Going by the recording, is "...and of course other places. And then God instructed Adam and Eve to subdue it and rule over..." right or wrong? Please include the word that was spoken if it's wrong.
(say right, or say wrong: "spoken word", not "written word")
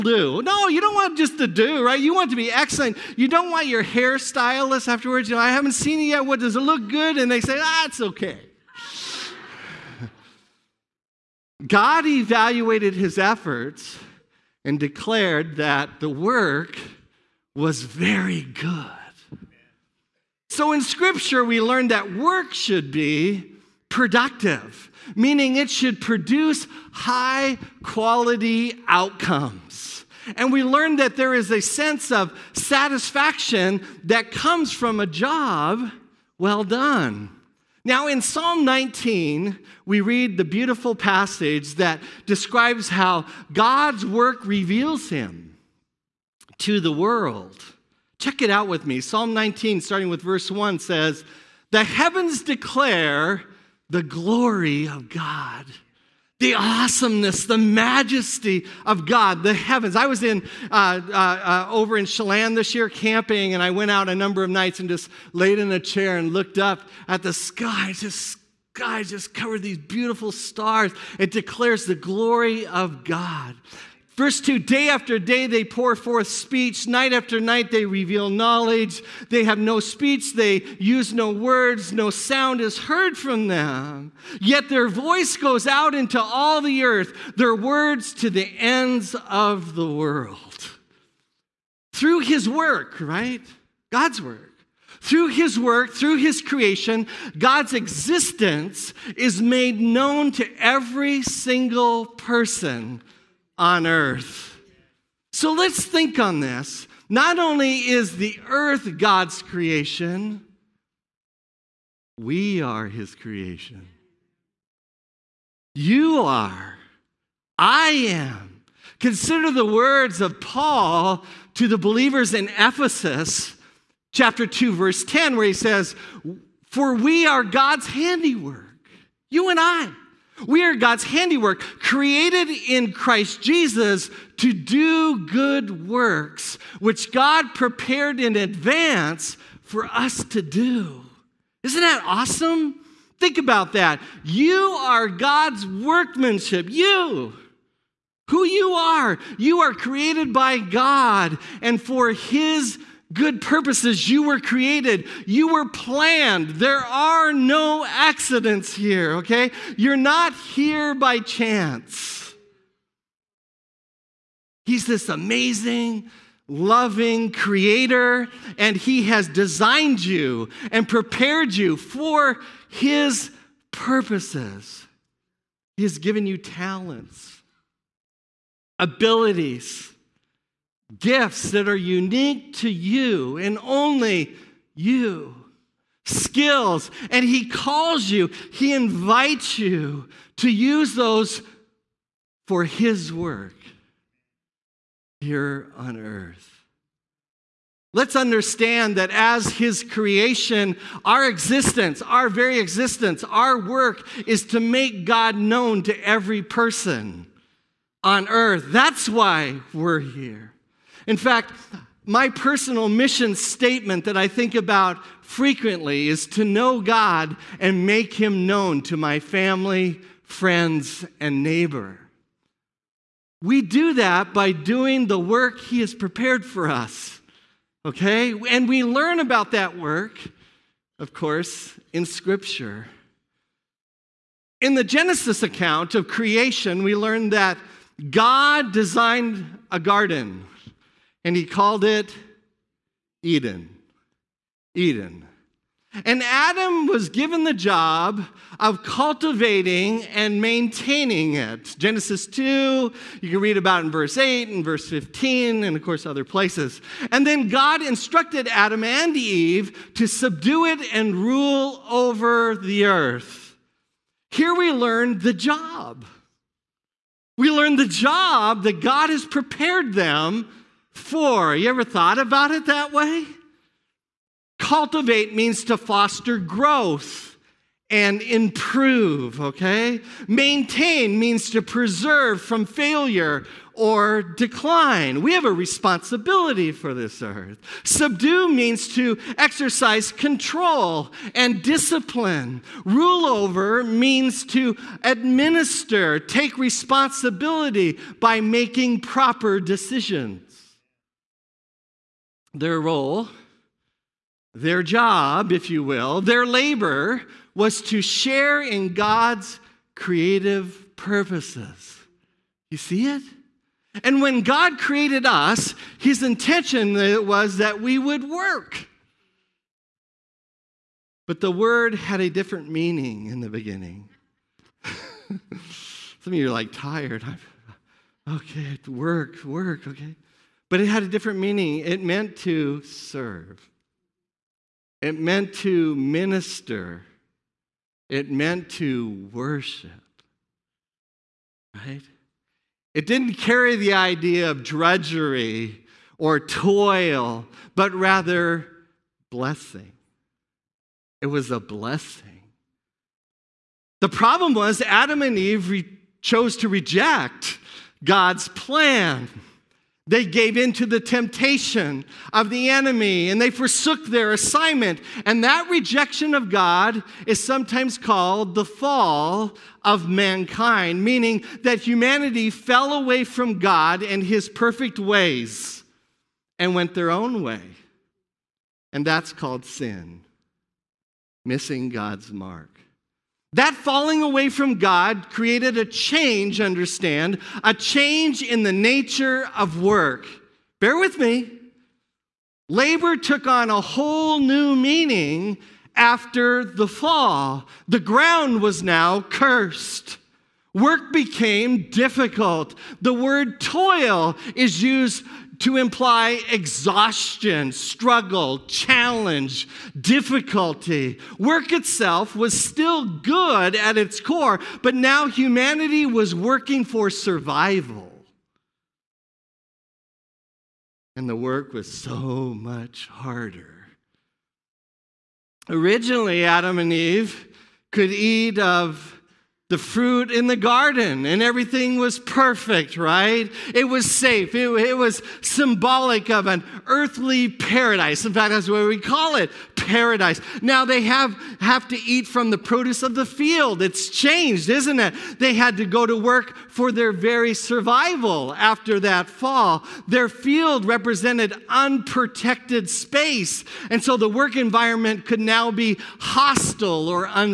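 right.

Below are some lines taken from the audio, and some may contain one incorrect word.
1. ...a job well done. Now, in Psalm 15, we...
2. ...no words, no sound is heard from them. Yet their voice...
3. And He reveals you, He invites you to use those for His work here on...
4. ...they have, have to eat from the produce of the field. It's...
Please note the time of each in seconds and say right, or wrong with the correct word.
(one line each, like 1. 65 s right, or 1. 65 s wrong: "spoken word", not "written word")
1. 35 s wrong: "19", not "15"
2. 81 s right
3. 187 s wrong: "calls", not "reveals"
4. 440 s right.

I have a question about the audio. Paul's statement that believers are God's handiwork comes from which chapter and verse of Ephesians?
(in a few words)
Chapter 2, verse 10.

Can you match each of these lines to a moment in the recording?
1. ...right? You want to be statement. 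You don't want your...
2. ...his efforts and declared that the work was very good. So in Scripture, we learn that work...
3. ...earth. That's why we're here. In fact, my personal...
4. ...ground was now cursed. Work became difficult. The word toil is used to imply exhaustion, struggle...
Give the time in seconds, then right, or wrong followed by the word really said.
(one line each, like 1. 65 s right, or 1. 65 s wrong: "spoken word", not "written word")
1. 1 s wrong: "excellent", not "statement"
2. 12 s right
3. 208 s right
4. 398 s right.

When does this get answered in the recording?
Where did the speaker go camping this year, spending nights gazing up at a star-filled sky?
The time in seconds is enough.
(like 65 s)
62 s.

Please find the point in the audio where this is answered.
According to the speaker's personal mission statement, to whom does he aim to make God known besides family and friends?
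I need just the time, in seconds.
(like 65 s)
221 s.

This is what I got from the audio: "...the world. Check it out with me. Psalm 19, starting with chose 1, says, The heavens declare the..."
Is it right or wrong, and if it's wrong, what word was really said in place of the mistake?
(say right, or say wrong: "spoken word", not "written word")
wrong: "verse", not "chose".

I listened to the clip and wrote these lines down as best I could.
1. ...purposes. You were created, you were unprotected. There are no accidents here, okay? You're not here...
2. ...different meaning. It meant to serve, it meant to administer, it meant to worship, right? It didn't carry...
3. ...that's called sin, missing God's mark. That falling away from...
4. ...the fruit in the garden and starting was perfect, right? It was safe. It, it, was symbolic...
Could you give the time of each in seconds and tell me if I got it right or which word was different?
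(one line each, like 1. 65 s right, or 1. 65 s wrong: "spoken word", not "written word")
1. 153 s wrong: "planned", not "unprotected"
2. 331 s wrong: "minister", not "administer"
3. 379 s right
4. 429 s wrong: "everything", not "starting".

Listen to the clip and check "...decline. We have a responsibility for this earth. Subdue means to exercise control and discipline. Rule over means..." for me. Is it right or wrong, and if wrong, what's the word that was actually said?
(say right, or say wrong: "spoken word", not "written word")
right.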